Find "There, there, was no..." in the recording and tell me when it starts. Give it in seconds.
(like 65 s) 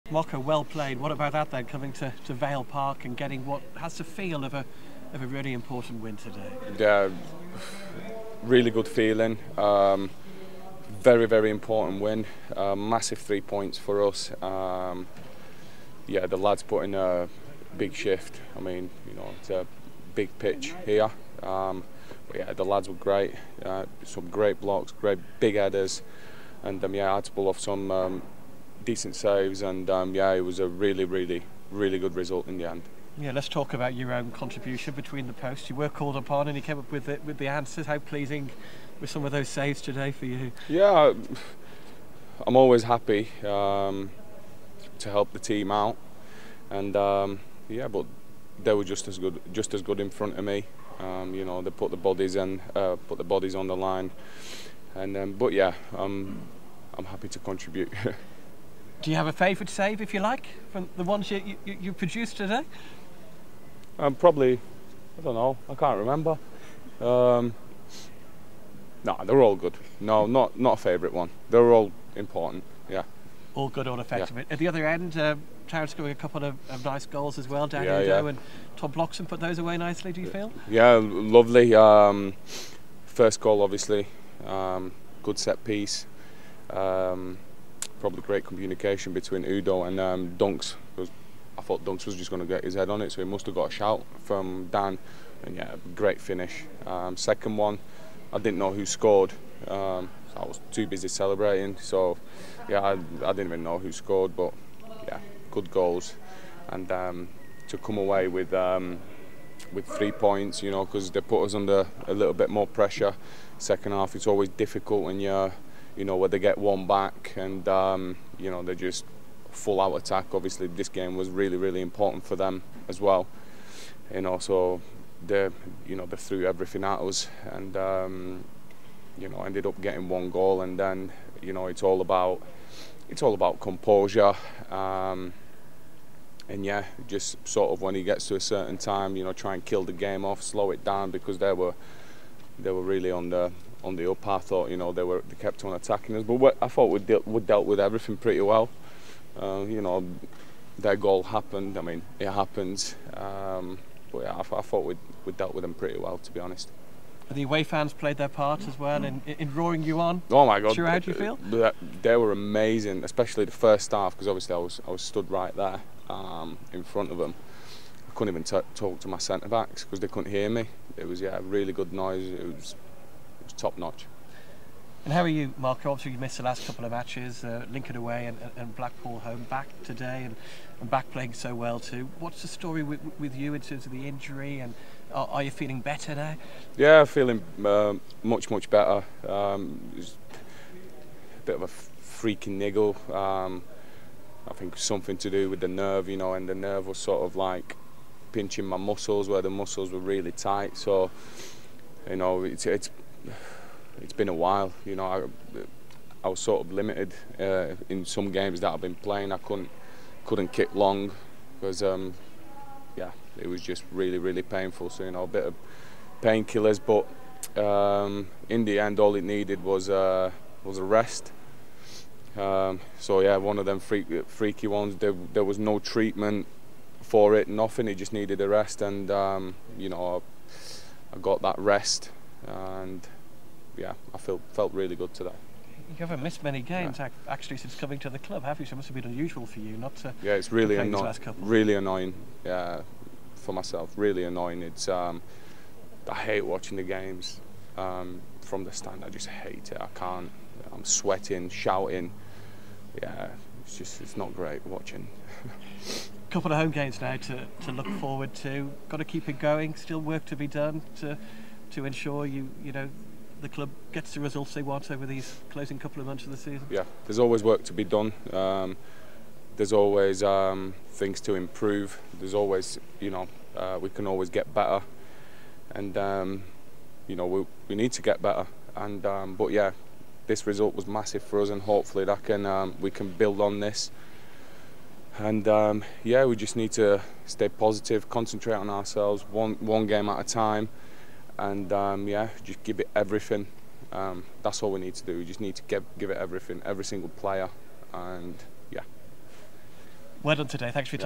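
224 s.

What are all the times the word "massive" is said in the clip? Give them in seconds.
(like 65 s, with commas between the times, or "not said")
12 s, 280 s.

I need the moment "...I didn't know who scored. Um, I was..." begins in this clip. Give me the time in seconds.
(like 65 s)
98 s.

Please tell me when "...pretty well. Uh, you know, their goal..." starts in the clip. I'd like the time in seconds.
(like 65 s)
148 s.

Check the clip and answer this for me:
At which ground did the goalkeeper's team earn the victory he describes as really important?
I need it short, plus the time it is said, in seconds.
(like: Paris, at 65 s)
Vale Park, at 2 s.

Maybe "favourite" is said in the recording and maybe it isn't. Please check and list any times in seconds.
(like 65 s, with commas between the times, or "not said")
59 s, 70 s.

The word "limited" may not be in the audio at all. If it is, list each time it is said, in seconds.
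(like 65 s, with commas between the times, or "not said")
206 s.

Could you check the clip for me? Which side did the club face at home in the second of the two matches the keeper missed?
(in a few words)
Blackpool.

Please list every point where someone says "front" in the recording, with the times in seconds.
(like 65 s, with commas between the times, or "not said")
50 s, 166 s.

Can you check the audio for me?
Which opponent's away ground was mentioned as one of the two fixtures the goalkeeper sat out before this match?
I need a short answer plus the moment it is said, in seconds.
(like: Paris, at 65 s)
Lincoln, at 177 s.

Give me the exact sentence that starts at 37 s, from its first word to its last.
How pleasing were some of those saves today for you?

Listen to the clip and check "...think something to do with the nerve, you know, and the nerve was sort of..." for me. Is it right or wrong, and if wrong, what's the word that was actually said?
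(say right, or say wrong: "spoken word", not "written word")
right.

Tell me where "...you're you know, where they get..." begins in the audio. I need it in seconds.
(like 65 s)
115 s.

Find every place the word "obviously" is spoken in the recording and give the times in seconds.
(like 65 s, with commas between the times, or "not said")
83 s, 120 s, 164 s, 175 s.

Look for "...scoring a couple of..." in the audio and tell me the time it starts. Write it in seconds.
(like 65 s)
75 s.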